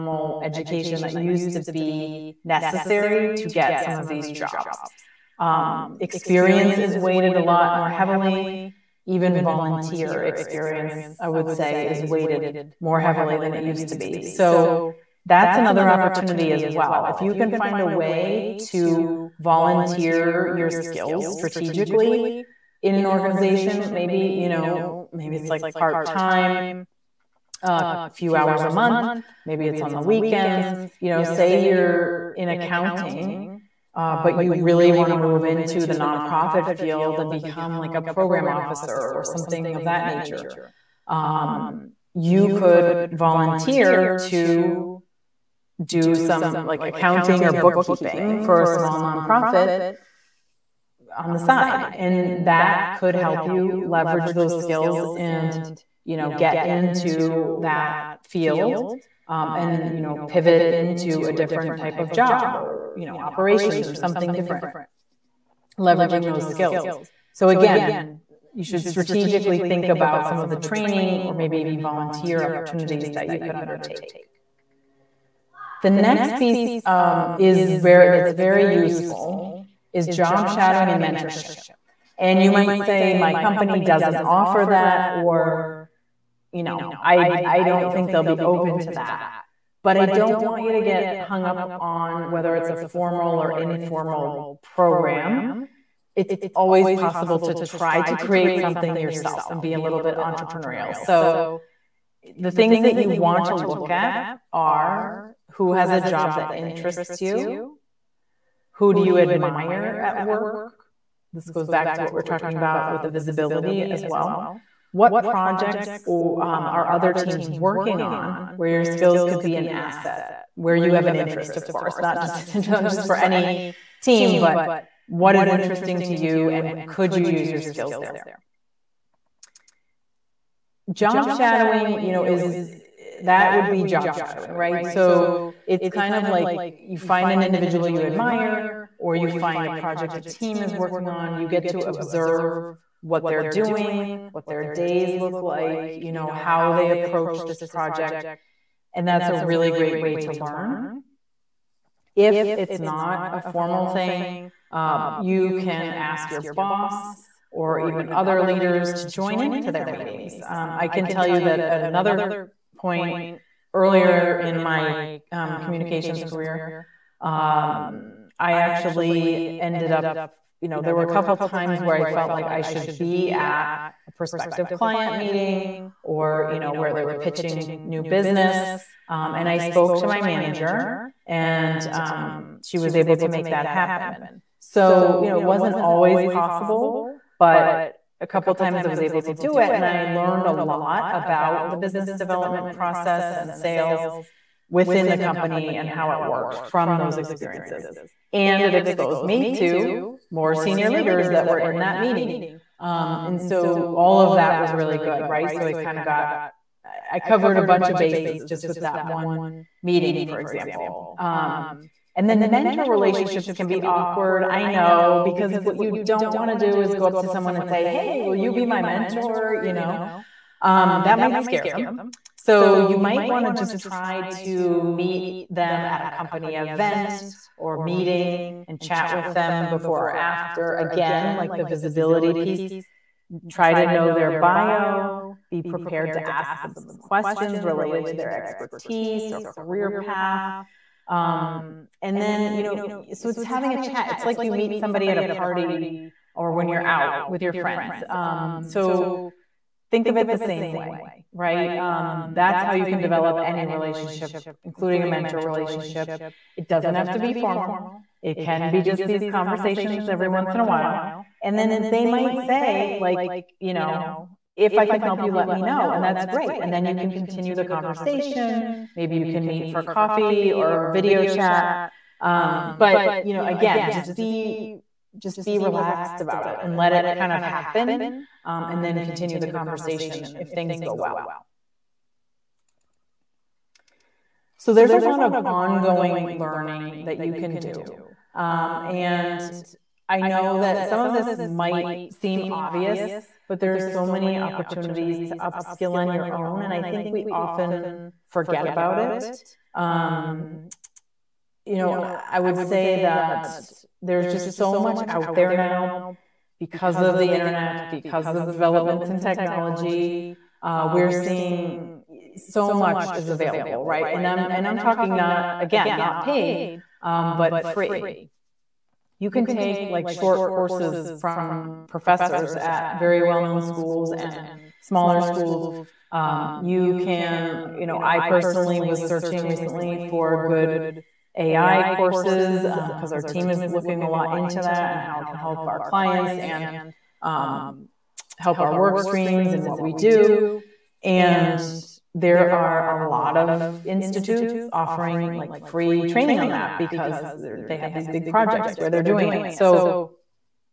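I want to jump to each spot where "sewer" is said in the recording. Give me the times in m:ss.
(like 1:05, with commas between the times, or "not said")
not said.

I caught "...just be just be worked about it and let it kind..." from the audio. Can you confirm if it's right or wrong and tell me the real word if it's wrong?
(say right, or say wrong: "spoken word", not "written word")
wrong: "relaxed", not "worked".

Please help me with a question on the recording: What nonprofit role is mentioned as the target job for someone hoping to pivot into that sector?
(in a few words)
Program officer.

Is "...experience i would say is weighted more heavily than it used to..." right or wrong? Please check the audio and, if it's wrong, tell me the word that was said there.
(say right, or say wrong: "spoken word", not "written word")
right.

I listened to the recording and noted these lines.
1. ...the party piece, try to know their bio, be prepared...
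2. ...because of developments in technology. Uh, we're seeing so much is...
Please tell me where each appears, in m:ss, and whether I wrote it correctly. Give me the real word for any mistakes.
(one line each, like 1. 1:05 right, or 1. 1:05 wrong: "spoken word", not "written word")
1. 3:51 wrong: "visibility", not "party"
2. 5:07 right.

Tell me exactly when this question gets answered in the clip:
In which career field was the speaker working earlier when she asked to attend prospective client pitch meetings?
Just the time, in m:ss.
2:45.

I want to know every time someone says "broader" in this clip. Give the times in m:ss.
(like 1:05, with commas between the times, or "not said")
not said.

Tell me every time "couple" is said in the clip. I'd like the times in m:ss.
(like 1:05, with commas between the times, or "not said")
2:51, 3:08.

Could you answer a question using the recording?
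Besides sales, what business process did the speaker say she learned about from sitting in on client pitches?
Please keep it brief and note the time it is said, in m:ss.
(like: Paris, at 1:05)
Business development, at 3:11.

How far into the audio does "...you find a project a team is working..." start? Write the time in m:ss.
2:19.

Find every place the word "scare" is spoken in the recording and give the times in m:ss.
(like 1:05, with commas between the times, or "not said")
3:41.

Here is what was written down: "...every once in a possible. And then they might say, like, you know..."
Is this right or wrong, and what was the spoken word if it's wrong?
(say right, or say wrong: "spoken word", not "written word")
wrong: "while", not "possible".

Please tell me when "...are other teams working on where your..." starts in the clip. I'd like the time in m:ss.
1:56.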